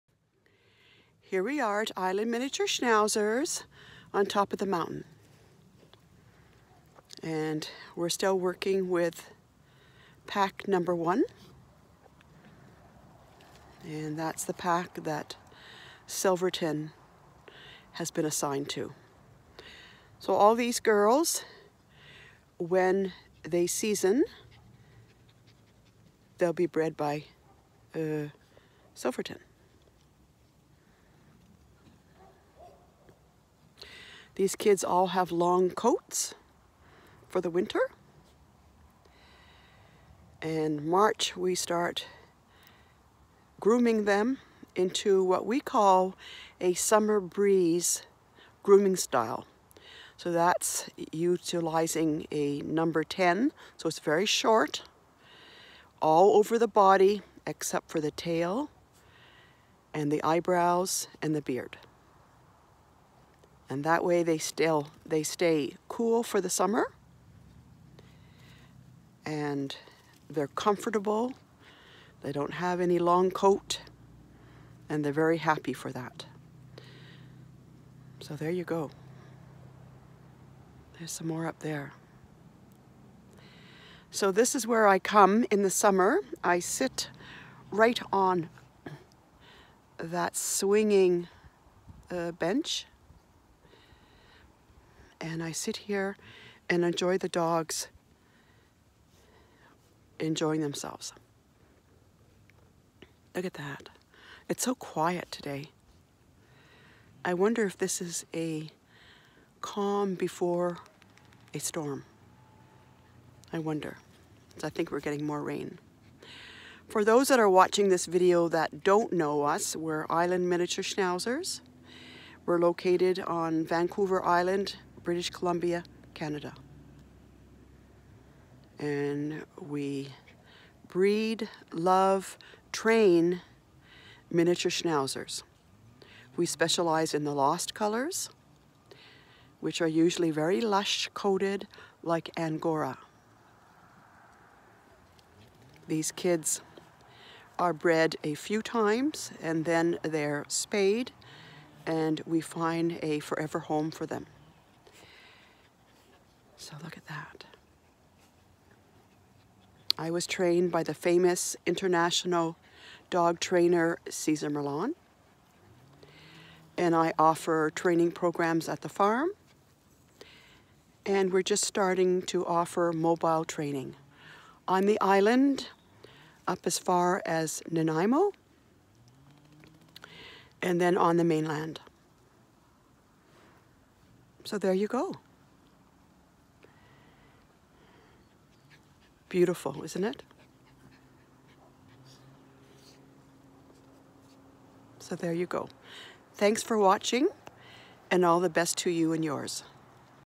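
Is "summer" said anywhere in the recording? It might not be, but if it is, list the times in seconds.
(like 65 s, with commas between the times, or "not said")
46 s, 66 s, 85 s.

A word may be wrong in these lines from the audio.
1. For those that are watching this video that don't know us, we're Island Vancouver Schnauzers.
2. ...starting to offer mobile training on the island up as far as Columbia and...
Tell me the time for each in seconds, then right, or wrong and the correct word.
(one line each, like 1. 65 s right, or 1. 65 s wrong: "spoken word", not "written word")
1. 116 s wrong: "Miniature", not "Vancouver"
2. 171 s wrong: "Nanaimo", not "Columbia".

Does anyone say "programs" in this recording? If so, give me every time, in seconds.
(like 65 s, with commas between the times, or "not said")
168 s.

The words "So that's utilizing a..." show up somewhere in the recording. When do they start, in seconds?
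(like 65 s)
50 s.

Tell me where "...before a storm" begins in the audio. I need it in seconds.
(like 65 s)
110 s.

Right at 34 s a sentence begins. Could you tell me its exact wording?
These kids all have long coats for the winter.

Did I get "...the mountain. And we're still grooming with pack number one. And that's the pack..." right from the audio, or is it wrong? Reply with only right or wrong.
wrong.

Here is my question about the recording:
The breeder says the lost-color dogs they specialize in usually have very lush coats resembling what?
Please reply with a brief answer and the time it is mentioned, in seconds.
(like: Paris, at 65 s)
Angora, at 142 s.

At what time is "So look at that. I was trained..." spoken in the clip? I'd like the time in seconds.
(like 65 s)
156 s.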